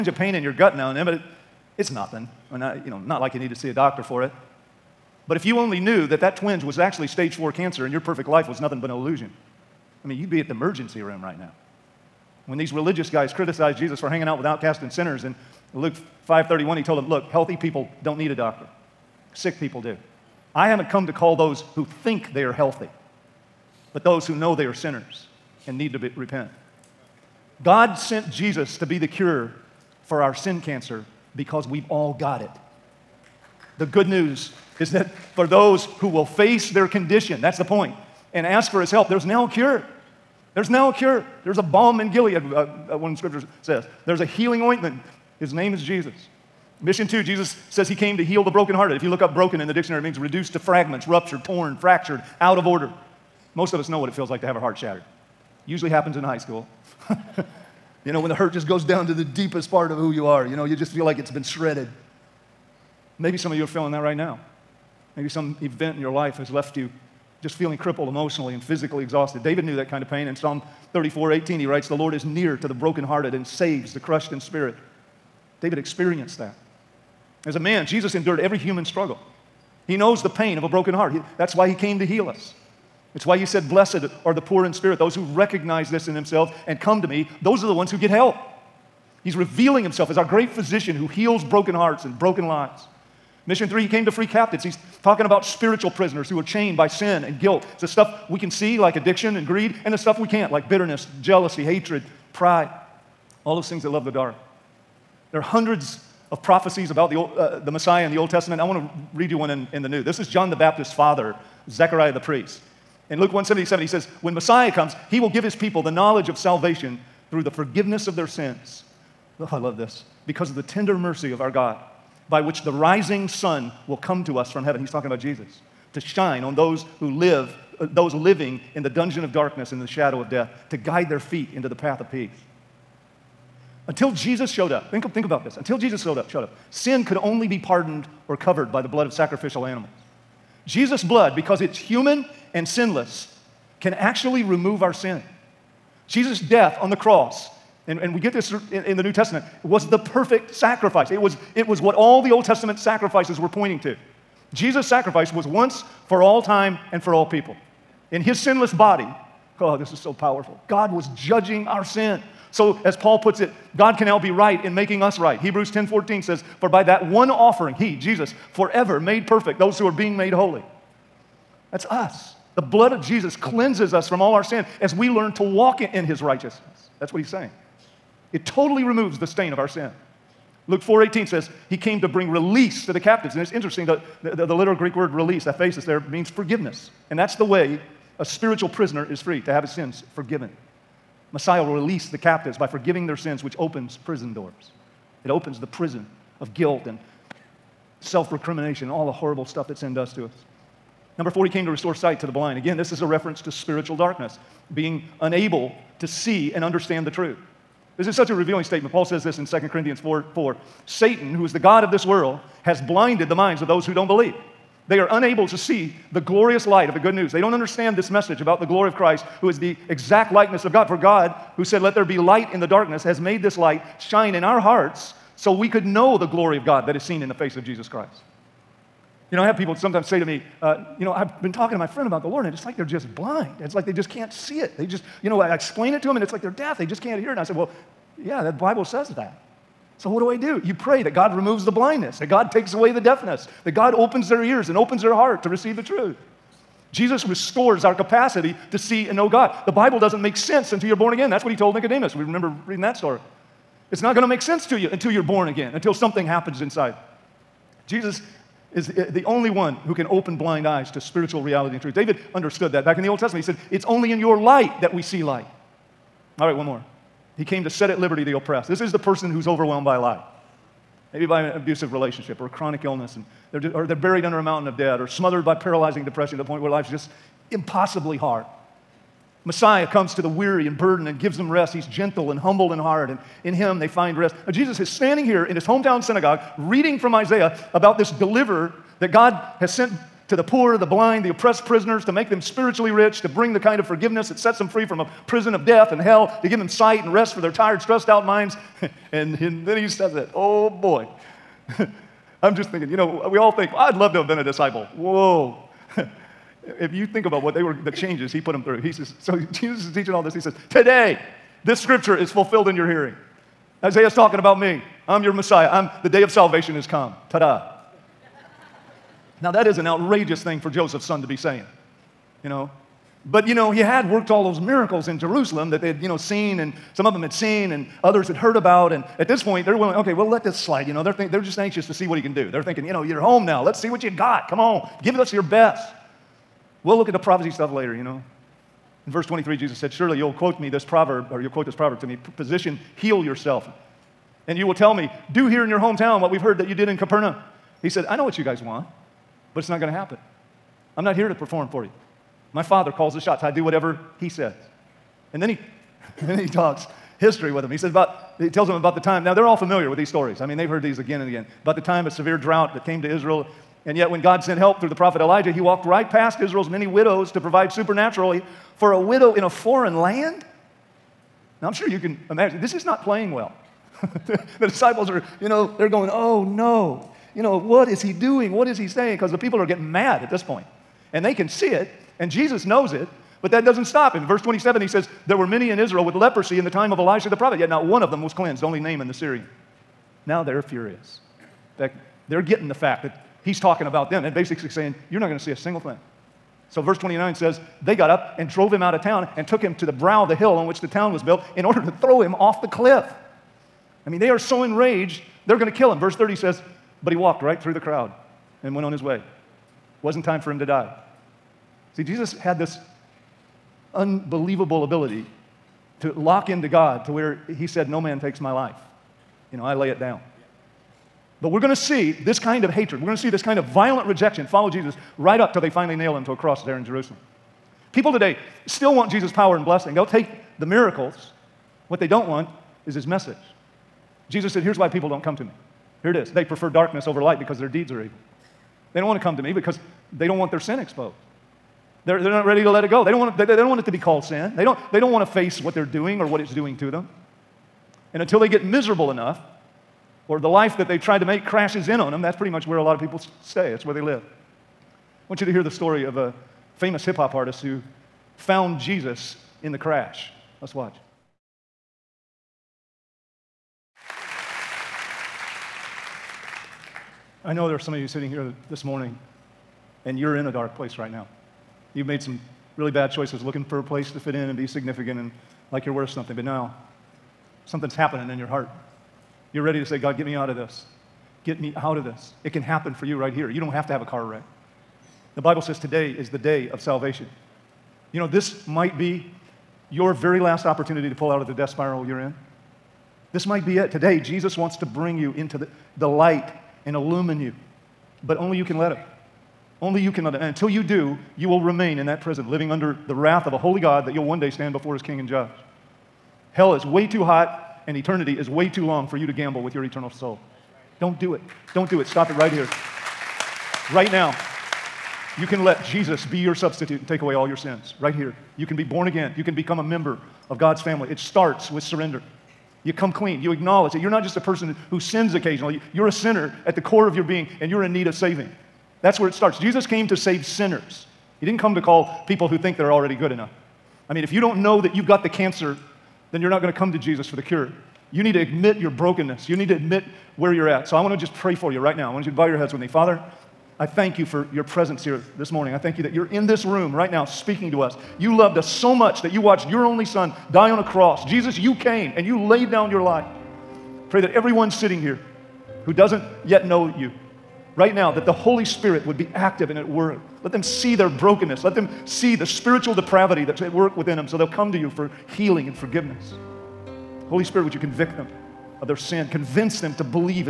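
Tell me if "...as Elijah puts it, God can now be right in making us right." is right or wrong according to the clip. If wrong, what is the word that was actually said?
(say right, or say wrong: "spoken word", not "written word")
wrong: "Paul", not "Elijah".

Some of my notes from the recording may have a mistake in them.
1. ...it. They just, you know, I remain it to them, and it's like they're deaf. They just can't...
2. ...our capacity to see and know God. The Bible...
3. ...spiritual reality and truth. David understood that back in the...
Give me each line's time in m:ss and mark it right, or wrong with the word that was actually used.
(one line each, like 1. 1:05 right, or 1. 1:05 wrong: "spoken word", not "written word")
1. 3:54 wrong: "explain", not "remain"
2. 4:07 right
3. 4:20 right.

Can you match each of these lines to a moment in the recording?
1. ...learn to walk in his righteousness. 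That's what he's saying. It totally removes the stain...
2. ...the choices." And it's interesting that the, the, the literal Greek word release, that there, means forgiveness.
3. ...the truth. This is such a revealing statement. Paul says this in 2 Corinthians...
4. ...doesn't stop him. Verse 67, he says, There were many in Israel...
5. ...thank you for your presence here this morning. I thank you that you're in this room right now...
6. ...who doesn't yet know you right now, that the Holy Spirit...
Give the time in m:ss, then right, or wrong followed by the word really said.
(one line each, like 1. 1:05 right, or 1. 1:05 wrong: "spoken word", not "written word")
1. 2:55 right
2. 3:02 wrong: "captives", not "choices"
3. 3:27 right
4. 6:23 wrong: "27", not "67"
5. 9:03 right
6. 9:15 right.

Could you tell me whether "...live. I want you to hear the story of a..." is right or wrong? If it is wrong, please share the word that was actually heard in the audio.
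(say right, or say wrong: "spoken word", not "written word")
right.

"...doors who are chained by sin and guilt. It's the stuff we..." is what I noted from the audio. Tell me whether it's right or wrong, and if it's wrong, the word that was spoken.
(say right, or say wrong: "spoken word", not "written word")
wrong: "prisoners", not "doors".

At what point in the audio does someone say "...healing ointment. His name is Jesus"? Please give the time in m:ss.
0:44.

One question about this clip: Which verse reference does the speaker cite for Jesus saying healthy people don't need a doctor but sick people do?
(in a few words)
Luke 5:31.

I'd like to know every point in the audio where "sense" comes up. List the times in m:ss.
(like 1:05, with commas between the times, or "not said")
4:10, 4:14.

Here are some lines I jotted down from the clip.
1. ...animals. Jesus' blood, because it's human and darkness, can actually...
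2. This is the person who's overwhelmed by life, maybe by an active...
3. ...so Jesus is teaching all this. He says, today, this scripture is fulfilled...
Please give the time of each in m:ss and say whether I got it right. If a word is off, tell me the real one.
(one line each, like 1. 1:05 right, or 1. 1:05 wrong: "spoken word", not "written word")
1. 2:19 wrong: "sinless", not "darkness"
2. 4:28 wrong: "abusive", not "active"
3. 5:09 right.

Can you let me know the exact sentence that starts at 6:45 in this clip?
Verse 30 says, But he walked right through the crowd and went on his way.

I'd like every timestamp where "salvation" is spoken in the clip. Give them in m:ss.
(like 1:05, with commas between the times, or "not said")
1:56, 5:16, 8:06.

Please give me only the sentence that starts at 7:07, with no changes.
People today still want Jesus' power and blessing.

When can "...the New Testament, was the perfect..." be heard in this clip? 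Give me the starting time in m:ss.
2:28.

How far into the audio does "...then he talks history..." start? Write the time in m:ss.
5:56.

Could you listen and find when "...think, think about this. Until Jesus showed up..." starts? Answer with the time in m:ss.
2:14.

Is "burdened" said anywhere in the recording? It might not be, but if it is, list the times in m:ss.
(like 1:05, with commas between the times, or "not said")
4:40.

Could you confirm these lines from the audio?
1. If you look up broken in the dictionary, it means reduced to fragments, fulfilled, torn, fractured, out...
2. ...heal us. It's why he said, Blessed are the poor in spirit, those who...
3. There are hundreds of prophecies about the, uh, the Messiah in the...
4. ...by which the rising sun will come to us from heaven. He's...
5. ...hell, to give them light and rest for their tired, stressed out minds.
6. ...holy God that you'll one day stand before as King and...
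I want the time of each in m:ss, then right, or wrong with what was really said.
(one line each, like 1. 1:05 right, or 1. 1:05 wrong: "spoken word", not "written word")
1. 0:48 wrong: "ruptured", not "fulfilled"
2. 1:22 right
3. 1:45 right
4. 2:02 right
5. 4:56 wrong: "sight", not "light"
6. 8:23 right.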